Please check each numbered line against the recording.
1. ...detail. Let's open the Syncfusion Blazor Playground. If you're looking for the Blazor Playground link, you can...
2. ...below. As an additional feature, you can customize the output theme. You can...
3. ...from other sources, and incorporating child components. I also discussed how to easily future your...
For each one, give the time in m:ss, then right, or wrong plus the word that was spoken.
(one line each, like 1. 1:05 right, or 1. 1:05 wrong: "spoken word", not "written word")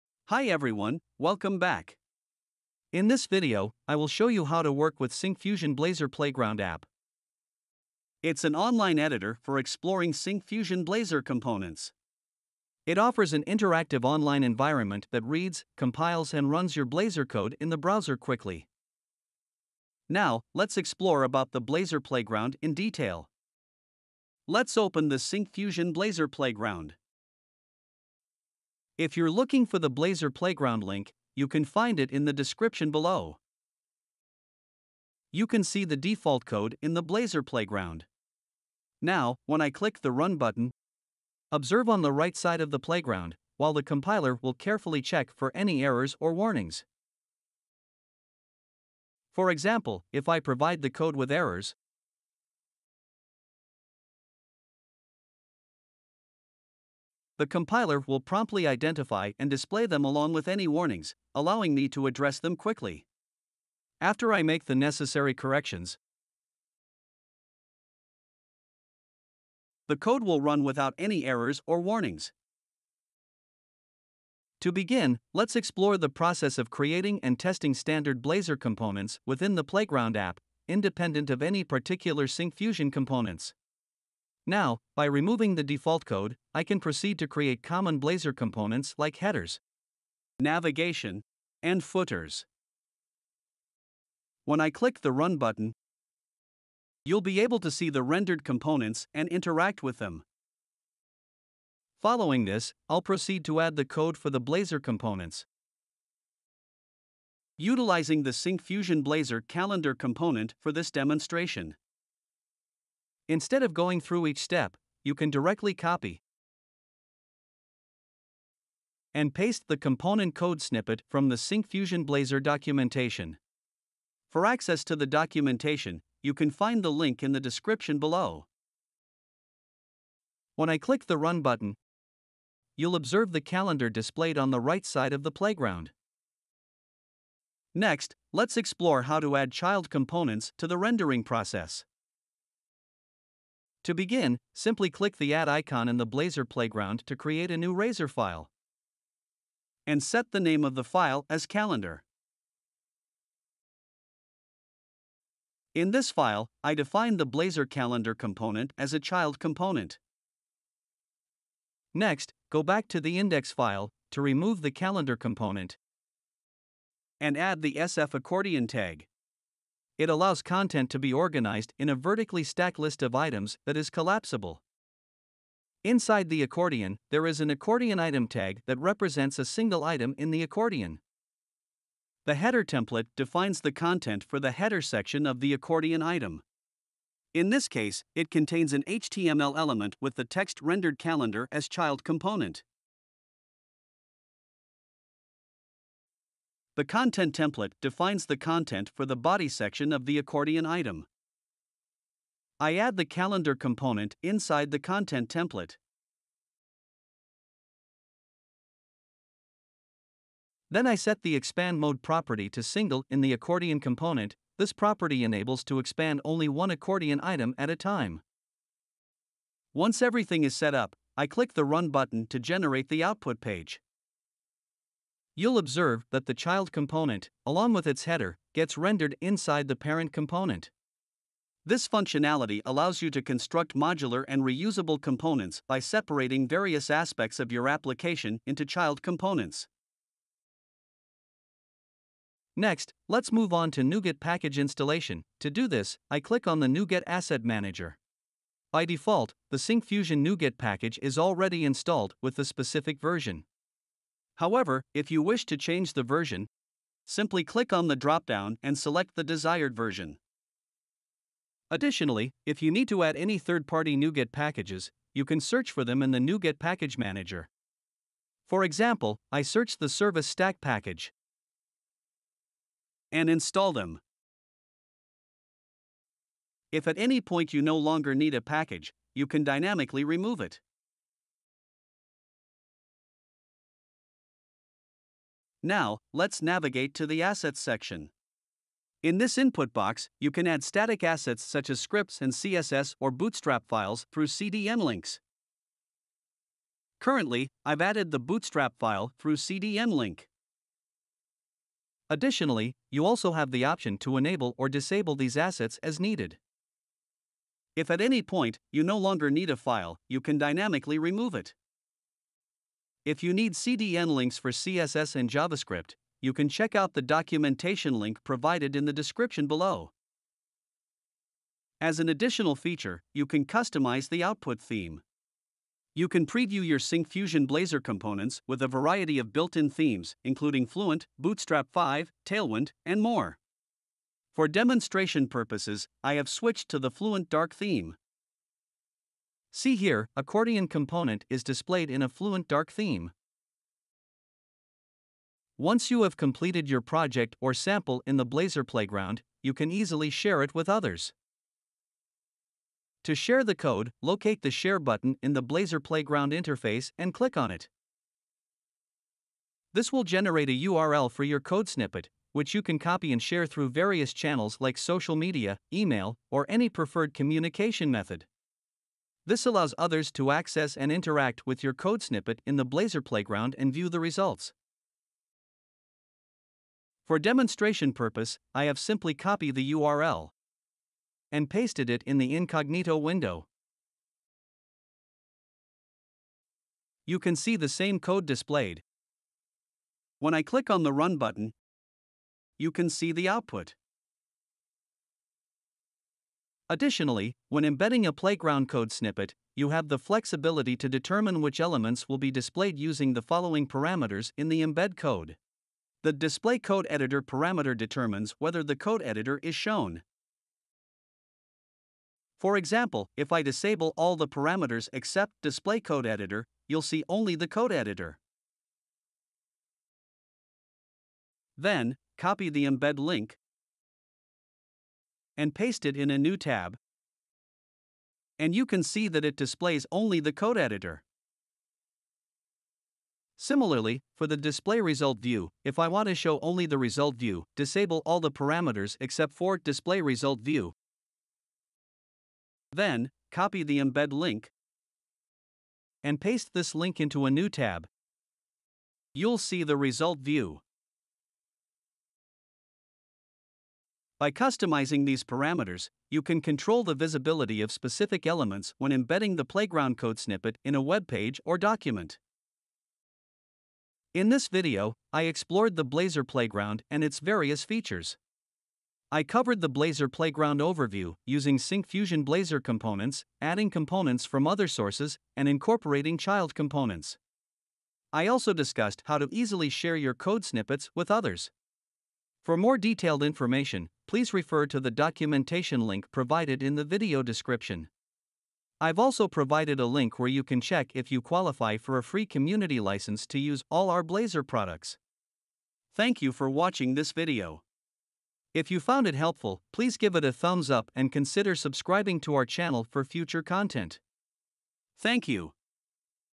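1. 0:22 right
2. 5:19 right
3. 7:54 wrong: "share", not "future".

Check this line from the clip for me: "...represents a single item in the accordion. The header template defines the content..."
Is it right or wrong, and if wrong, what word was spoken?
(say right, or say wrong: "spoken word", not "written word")
right.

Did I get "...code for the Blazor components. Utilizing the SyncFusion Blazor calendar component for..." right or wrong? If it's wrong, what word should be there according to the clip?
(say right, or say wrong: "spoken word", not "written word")
right.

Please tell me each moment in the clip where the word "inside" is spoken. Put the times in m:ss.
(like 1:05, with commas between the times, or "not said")
2:55, 3:24, 3:49.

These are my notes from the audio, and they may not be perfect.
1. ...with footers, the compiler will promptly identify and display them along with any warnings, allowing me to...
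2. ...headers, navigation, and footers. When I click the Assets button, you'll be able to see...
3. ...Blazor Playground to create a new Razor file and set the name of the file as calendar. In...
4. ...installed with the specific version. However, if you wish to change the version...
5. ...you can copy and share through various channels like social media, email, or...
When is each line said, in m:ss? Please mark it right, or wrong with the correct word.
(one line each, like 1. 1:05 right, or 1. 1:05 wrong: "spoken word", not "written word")
1. 0:51 wrong: "errors", not "footers"
2. 1:29 wrong: "Run", not "Assets"
3. 2:26 right
4. 4:11 right
5. 6:02 right.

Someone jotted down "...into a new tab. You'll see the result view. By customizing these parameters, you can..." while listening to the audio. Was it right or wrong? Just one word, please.
right.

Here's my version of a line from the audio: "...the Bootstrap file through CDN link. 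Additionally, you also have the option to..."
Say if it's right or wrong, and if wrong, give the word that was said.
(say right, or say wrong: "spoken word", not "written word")
right.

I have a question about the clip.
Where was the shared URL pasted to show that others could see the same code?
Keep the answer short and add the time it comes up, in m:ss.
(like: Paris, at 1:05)
incognito window, at 6:22.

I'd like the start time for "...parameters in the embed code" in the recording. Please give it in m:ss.
6:43.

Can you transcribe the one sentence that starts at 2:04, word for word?
For access to the documentation, you can find the link in the description below.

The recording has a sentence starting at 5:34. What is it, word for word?
For demonstration purposes, I have switched to the Fluent Dark theme.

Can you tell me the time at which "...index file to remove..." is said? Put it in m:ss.
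2:43.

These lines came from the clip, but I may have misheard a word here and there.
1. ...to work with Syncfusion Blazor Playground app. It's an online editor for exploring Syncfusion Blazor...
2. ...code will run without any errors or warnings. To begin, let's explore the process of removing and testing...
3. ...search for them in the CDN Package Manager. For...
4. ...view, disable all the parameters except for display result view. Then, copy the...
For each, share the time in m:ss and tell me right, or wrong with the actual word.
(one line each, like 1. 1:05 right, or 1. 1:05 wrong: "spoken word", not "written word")
1. 0:04 right
2. 1:09 wrong: "creating", not "removing"
3. 4:25 wrong: "NuGet", not "CDN"
4. 7:17 right.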